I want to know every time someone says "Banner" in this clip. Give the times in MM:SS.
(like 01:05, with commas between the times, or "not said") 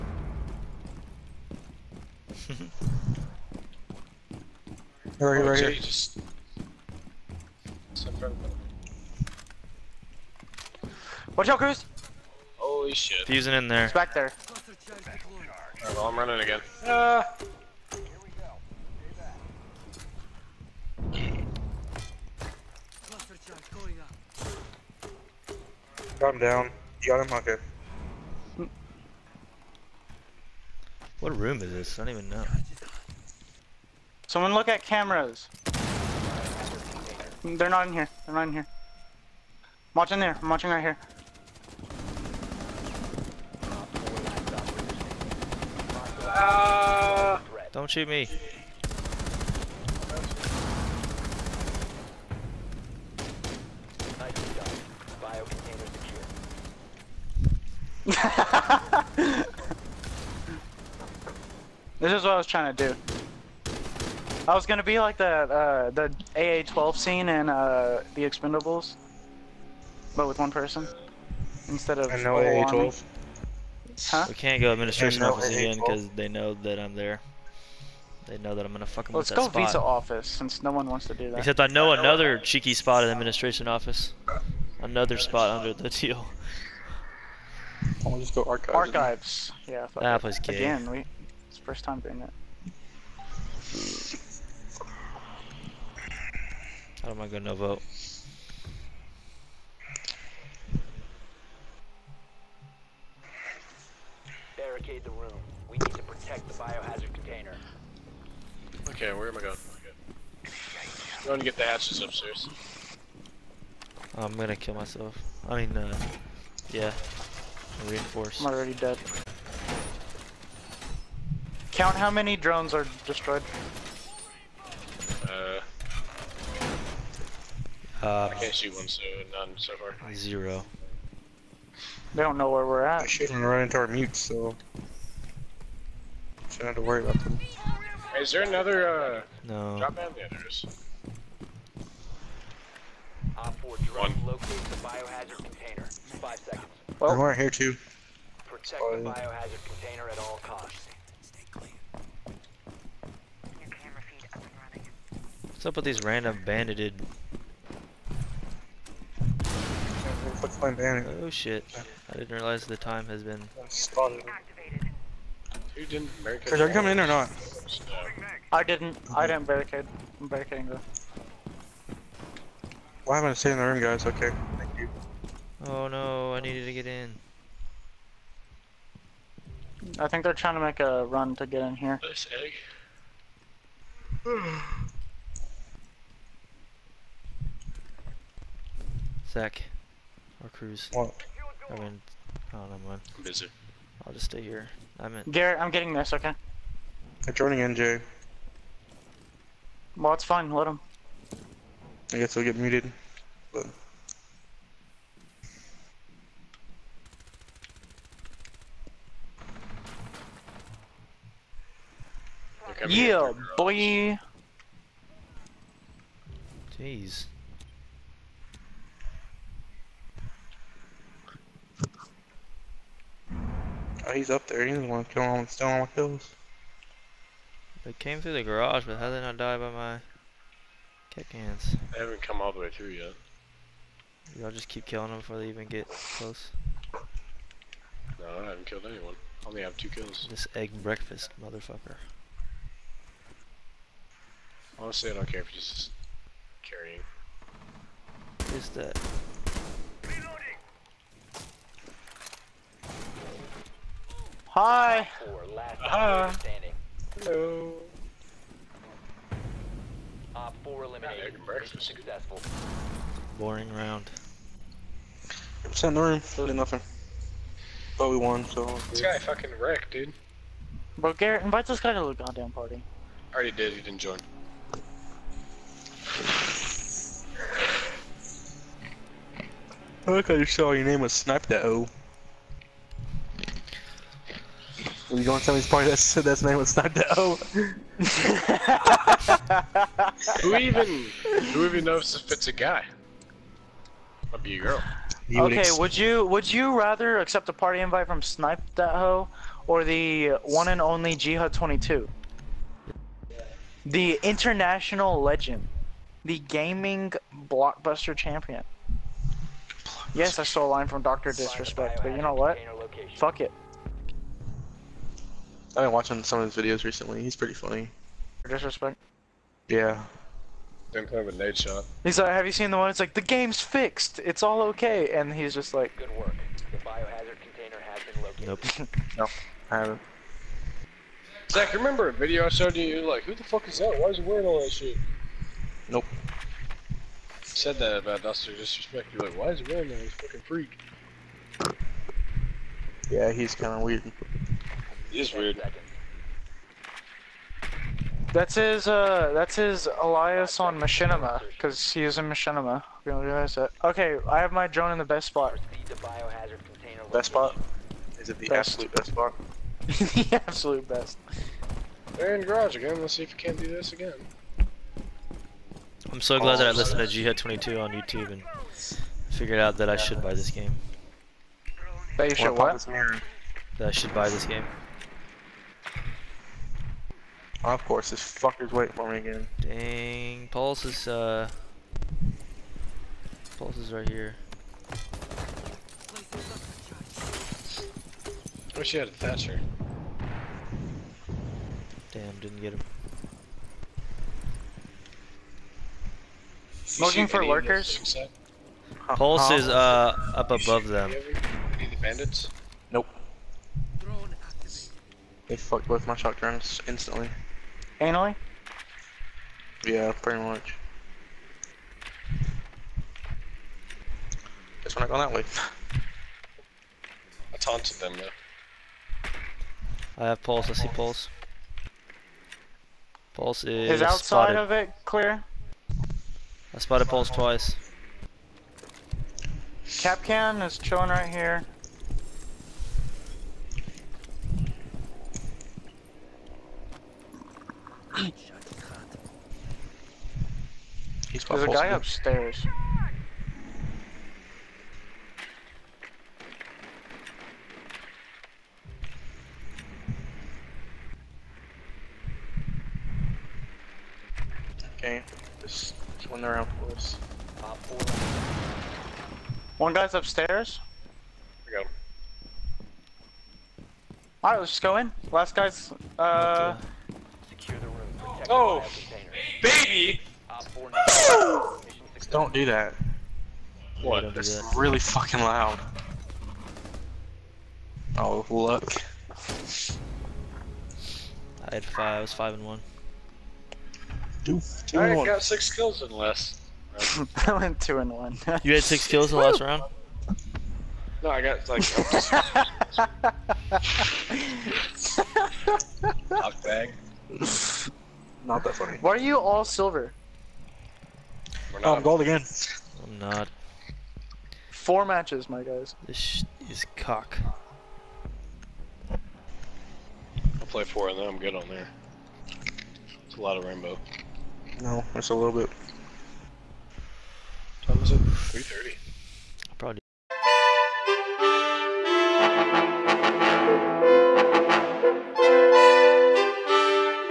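02:41.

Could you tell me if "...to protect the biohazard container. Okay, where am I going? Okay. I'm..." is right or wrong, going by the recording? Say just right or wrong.
right.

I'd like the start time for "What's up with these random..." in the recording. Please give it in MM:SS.
02:35.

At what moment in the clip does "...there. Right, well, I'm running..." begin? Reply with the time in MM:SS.
00:14.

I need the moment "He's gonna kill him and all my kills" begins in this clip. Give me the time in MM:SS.
03:44.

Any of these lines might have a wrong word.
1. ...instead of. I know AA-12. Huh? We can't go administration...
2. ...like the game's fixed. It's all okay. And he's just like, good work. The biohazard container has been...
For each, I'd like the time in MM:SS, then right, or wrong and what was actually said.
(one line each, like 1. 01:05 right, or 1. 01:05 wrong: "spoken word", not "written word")
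1. 01:11 right
2. 05:23 right.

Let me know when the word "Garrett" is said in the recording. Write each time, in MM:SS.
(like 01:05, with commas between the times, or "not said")
03:15, 04:31.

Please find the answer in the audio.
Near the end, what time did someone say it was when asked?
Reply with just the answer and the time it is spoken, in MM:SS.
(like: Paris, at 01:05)
3:30, at 08:38.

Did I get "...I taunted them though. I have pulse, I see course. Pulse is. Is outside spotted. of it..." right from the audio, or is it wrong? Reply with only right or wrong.
wrong.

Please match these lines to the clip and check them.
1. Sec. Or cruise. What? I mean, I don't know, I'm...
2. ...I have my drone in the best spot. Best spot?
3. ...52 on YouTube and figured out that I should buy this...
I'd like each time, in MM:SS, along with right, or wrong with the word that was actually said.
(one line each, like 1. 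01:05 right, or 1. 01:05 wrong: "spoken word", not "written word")
1. 03:09 right
2. 05:54 right
3. 06:07 wrong: "22", not "52".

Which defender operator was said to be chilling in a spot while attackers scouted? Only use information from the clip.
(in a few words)
Kapkan.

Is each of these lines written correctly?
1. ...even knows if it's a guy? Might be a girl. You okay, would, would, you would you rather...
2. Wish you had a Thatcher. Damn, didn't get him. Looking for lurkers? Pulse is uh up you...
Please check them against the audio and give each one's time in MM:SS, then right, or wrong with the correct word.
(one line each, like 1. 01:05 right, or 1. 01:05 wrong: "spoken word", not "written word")
1. 04:51 right
2. 06:28 right.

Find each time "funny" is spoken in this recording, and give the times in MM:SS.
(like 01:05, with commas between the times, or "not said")
05:17, 08:18.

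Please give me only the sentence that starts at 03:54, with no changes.
Y'all just keep killing them before they even get close.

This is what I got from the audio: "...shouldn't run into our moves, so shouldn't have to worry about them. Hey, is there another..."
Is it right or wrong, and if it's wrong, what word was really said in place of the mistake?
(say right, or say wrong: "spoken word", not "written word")
wrong: "mutes", not "moves".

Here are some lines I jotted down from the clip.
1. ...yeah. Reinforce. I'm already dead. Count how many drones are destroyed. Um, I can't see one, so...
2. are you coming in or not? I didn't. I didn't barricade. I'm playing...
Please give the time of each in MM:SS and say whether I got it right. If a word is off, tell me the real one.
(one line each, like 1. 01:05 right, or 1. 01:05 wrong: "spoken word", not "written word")
1. 01:56 right
2. 02:46 wrong: "barricading", not "playing".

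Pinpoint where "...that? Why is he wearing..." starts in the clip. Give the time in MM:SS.
05:33.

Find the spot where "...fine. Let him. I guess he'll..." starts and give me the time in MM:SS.
03:20.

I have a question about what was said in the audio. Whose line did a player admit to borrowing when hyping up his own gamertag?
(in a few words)
Dr. Disrespect.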